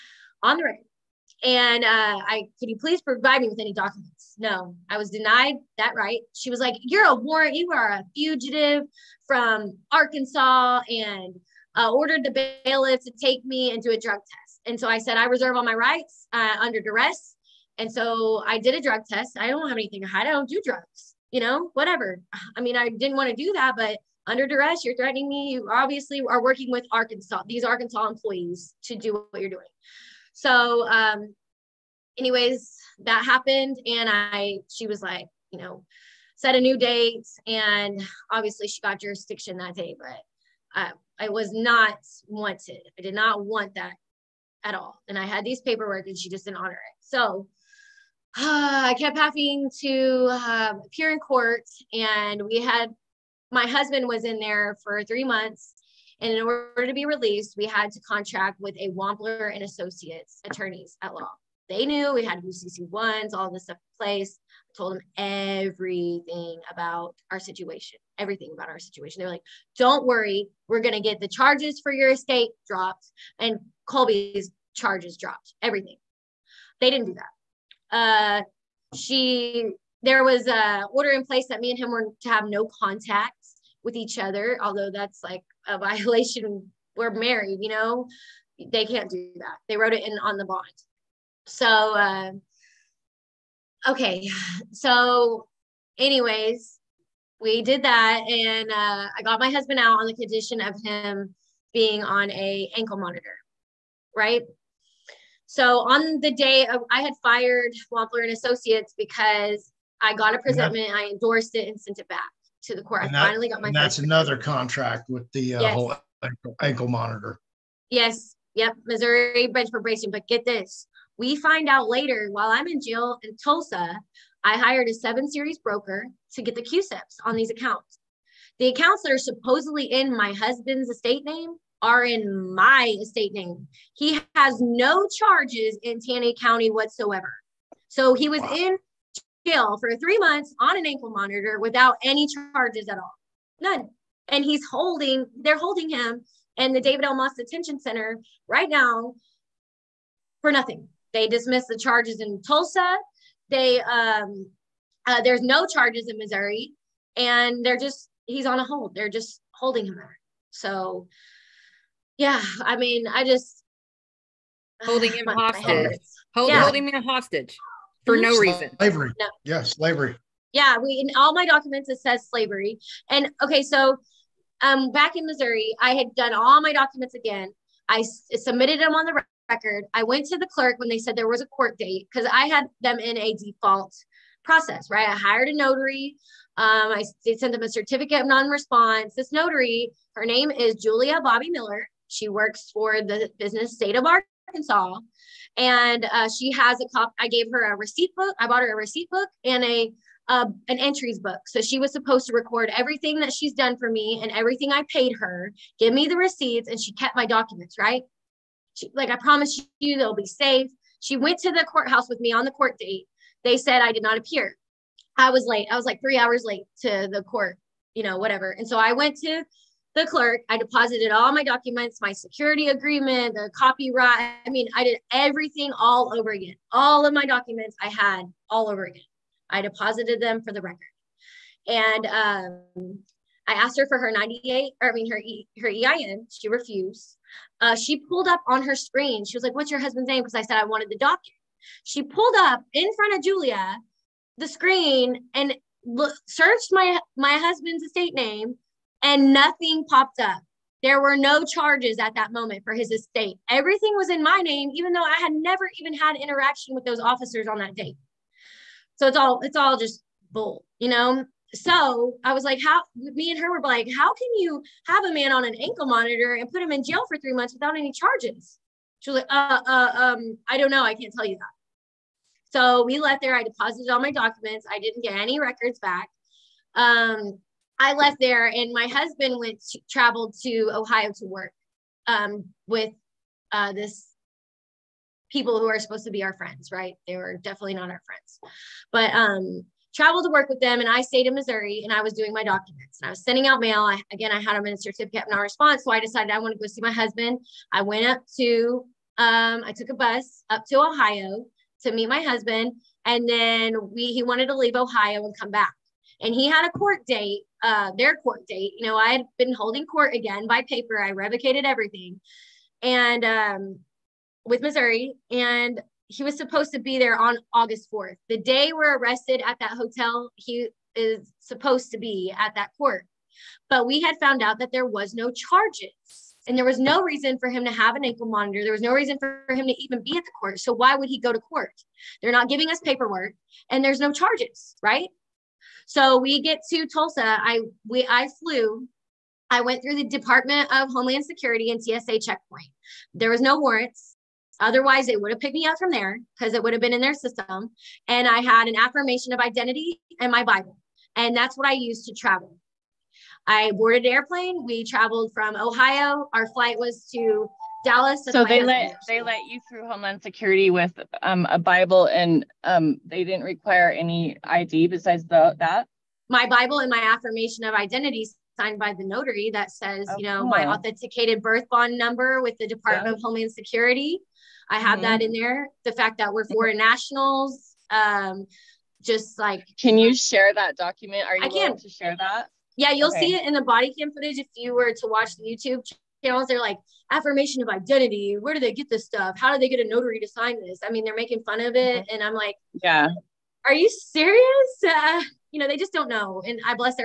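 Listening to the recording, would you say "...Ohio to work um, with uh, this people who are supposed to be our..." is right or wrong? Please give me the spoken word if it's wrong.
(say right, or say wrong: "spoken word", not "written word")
right.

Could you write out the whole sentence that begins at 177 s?
I s- submitted them on the record.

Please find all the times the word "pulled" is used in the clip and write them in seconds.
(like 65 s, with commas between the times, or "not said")
237 s, 242 s.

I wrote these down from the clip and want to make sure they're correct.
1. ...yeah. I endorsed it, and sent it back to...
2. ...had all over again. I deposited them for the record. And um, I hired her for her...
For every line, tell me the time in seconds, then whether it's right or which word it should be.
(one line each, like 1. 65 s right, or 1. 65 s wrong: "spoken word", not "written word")
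1. 110 s right
2. 227 s wrong: "asked", not "hired".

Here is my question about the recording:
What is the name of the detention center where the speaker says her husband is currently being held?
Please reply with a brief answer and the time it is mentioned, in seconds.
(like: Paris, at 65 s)
David L. Moss Detention Center, at 146 s.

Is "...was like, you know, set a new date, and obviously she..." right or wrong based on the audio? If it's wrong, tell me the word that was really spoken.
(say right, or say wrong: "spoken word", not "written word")
right.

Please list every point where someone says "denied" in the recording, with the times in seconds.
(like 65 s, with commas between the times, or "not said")
5 s.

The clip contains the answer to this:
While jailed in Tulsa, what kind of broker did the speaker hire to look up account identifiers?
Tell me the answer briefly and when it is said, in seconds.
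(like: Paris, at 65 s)
Seven series broker, at 124 s.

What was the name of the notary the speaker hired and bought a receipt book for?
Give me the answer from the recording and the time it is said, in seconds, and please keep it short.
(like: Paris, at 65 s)
Julia Bobby Miller, at 190 s.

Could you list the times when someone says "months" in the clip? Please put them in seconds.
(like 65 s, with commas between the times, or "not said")
55 s, 140 s, 267 s.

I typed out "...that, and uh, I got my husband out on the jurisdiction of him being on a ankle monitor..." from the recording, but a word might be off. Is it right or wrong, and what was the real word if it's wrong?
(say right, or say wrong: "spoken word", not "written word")
wrong: "condition", not "jurisdiction".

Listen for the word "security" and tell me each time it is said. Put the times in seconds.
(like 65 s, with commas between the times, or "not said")
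222 s, 341 s, 360 s, 373 s.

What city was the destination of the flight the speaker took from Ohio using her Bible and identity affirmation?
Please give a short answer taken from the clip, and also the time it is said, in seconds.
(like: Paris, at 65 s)
Dallas, at 357 s.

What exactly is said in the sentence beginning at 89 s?
They wrote it in on the bond.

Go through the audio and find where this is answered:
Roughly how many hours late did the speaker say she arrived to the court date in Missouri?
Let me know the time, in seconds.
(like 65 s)
215 s.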